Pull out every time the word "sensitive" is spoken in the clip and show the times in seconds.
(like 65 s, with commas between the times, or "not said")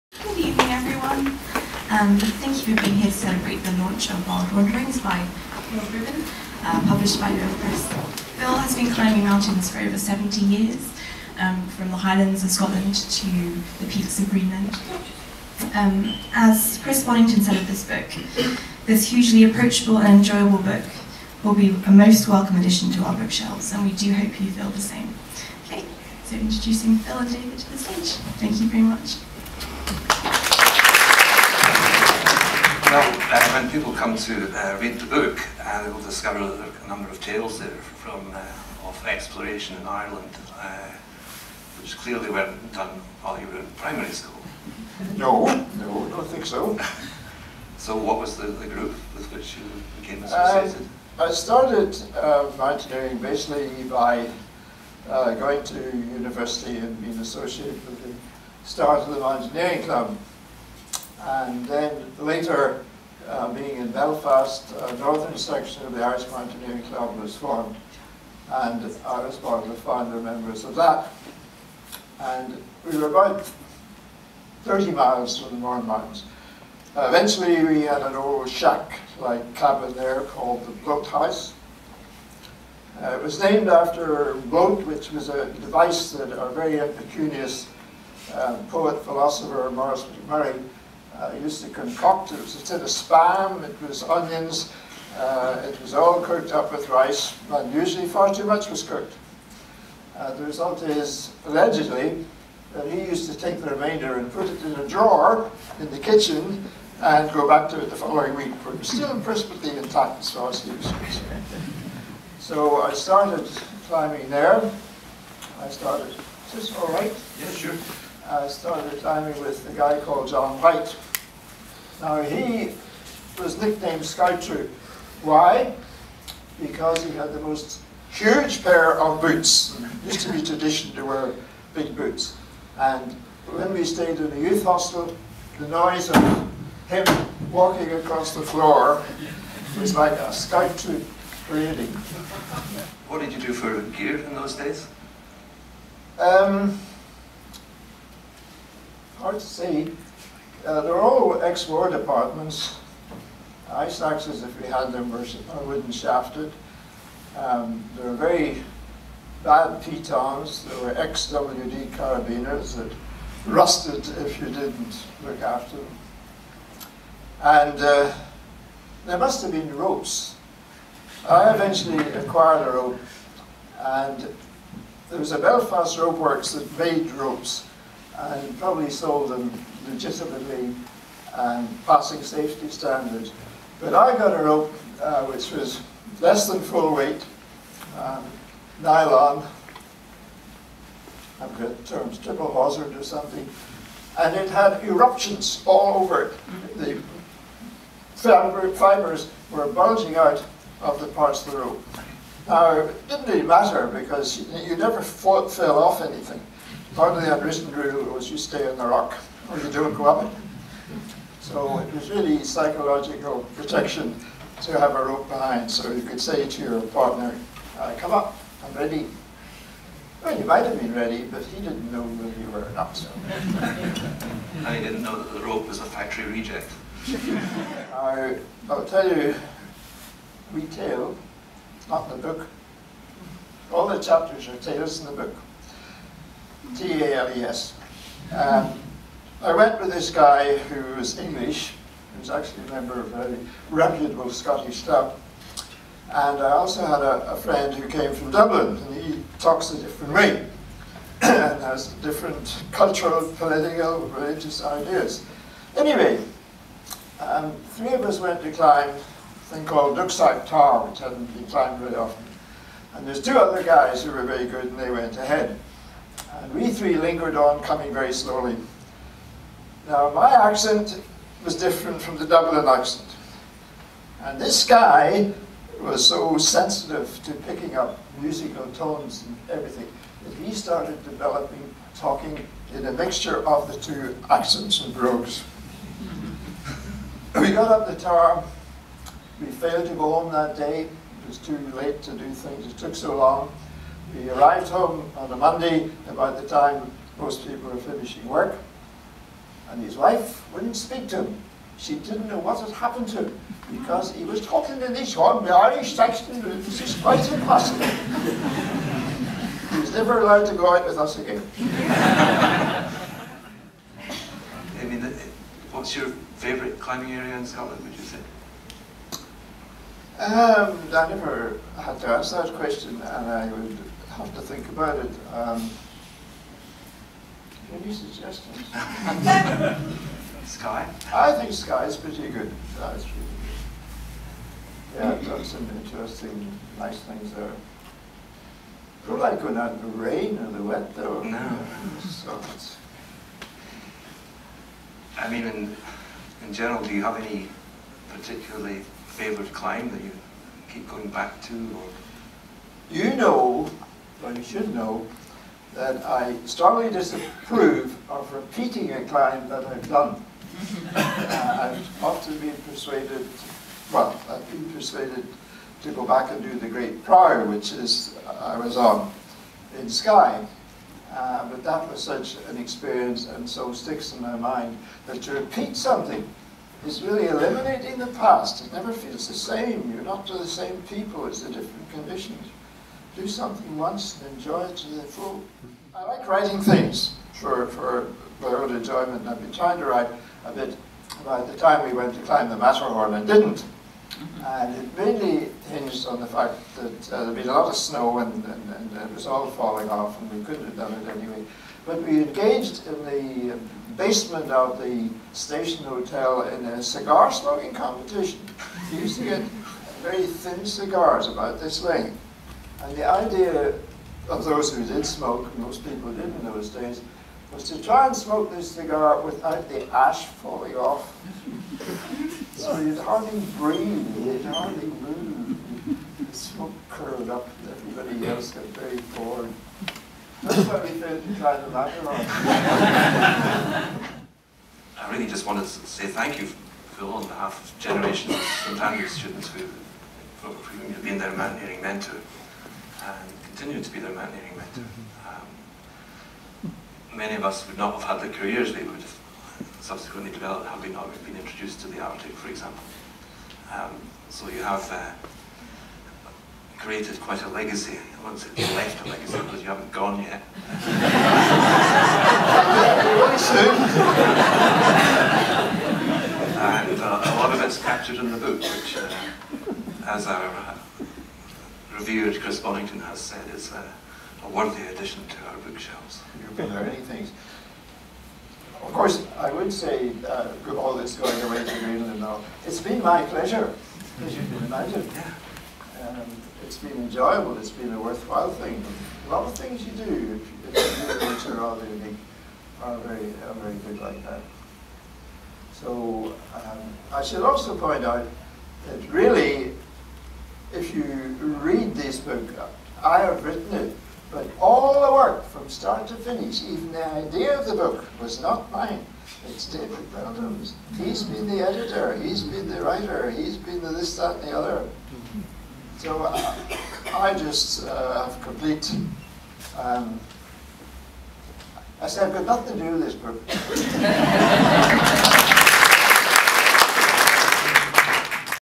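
276 s.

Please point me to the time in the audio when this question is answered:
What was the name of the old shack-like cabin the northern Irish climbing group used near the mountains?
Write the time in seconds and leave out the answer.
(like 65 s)
80 s.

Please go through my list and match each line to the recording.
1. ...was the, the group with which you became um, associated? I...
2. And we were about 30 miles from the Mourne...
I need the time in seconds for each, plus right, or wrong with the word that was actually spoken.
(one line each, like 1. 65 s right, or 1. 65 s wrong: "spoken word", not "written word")
1. 48 s right
2. 72 s right.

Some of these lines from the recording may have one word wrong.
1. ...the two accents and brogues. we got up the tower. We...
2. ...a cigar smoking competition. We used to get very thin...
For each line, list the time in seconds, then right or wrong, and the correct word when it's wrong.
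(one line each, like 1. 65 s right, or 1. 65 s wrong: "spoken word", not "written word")
1. 283 s right
2. 406 s right.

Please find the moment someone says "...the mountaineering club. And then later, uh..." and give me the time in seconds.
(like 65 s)
59 s.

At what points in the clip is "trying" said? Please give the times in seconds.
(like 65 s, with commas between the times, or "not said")
389 s.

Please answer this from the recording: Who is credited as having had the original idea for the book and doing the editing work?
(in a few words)
David Brandon.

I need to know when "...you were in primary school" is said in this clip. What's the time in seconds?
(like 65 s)
43 s.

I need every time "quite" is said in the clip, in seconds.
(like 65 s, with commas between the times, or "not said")
307 s, 457 s.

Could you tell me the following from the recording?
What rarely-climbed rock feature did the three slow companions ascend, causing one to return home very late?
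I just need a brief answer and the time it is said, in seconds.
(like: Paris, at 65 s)
Duckside Tower, at 259 s.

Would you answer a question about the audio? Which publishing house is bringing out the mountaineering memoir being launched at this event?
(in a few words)
Luath Press.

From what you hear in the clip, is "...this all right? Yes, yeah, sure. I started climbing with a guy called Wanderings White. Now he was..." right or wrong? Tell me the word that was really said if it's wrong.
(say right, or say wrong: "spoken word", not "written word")
wrong: "John", not "Wanderings".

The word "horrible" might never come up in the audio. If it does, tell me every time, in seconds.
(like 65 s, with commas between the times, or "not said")
not said.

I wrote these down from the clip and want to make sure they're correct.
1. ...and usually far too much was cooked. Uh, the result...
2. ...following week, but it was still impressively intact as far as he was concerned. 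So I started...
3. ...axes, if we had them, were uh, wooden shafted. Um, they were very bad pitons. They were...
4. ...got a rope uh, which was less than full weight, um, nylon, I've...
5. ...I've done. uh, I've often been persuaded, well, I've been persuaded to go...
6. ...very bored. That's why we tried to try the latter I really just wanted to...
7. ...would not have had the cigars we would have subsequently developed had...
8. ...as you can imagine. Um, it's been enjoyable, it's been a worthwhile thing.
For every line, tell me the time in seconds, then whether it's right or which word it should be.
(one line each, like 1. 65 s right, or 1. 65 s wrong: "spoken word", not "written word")
1. 97 s right
2. 107 s right
3. 154 s right
4. 184 s right
5. 359 s right
6. 428 s right
7. 447 s wrong: "careers", not "cigars"
8. 484 s right.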